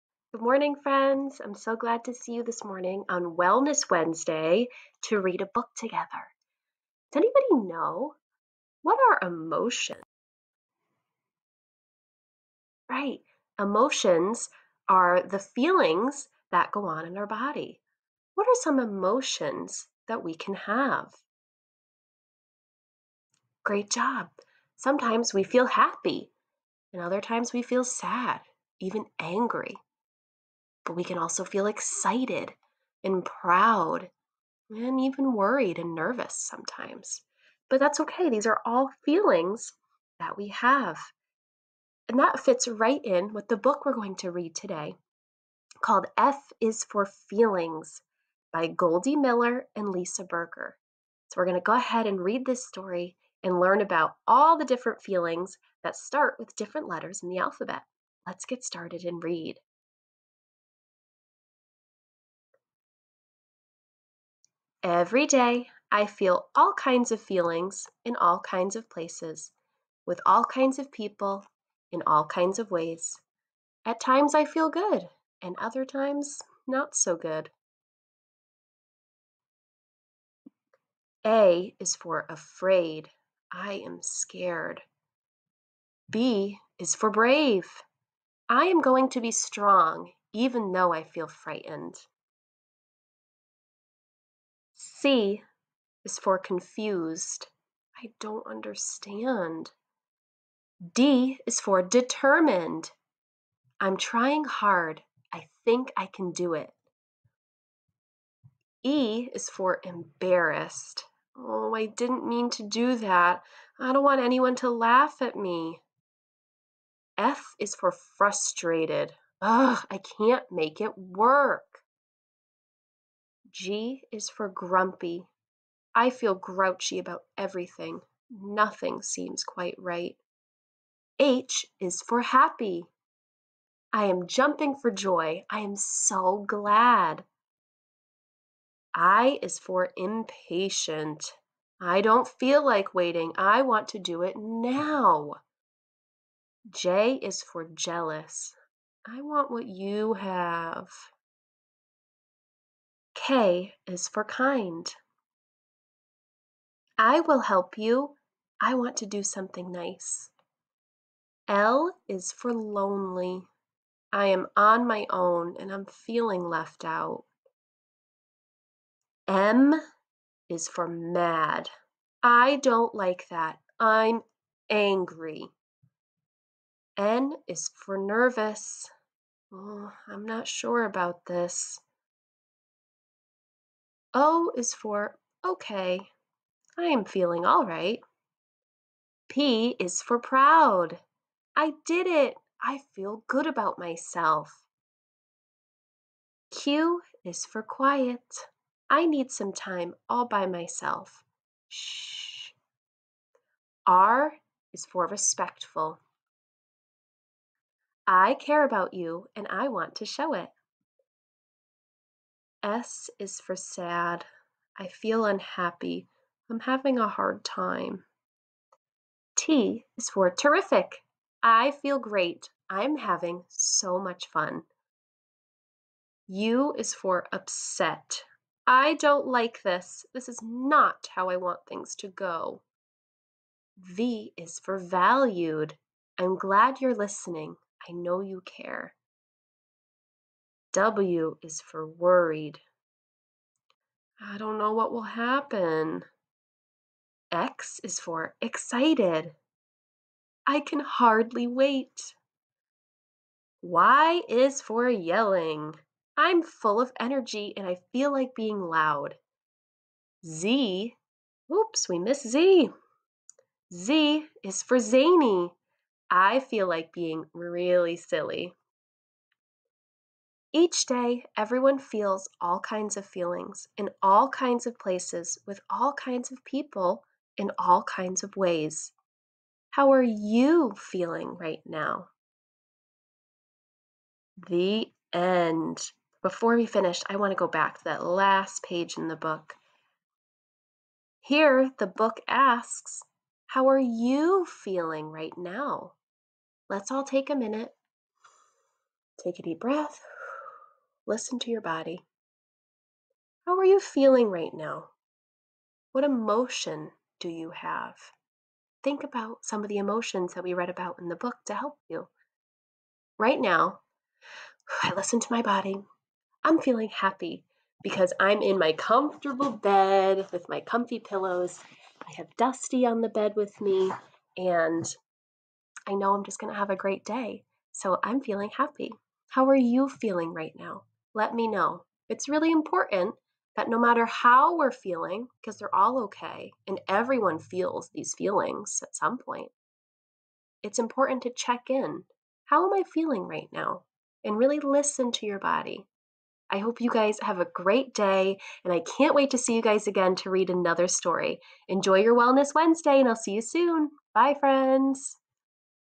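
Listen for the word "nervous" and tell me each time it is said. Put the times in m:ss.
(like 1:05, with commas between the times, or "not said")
0:35, 2:57.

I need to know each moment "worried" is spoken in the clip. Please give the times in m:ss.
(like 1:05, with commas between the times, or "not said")
0:35, 4:01.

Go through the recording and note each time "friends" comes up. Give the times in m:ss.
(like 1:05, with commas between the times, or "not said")
0:00, 5:54.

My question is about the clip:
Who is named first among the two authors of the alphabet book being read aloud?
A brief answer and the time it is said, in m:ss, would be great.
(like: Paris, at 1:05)
Goldie Millar, at 0:48.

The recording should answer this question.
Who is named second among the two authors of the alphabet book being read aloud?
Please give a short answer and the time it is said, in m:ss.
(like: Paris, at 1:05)
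Lisa Berger, at 0:49.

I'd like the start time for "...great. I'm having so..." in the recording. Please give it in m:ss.
3:41.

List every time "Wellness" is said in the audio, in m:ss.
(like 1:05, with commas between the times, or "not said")
0:03, 5:52.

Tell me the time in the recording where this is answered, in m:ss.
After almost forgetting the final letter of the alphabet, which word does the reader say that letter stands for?
4:24.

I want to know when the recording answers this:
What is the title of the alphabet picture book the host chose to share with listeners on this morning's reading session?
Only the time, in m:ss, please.
0:46.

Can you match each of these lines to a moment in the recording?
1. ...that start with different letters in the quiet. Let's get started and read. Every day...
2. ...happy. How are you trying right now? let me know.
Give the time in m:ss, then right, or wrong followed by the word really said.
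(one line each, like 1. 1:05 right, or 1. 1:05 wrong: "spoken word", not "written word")
1. 0:55 wrong: "alphabet", not "quiet"
2. 5:28 wrong: "feeling", not "trying".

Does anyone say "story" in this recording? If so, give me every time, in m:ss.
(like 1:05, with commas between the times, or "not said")
0:52, 5:50.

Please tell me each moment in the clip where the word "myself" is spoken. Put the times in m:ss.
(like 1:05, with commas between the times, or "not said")
3:13, 3:20.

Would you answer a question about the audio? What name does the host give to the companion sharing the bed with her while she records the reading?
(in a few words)
Dusty.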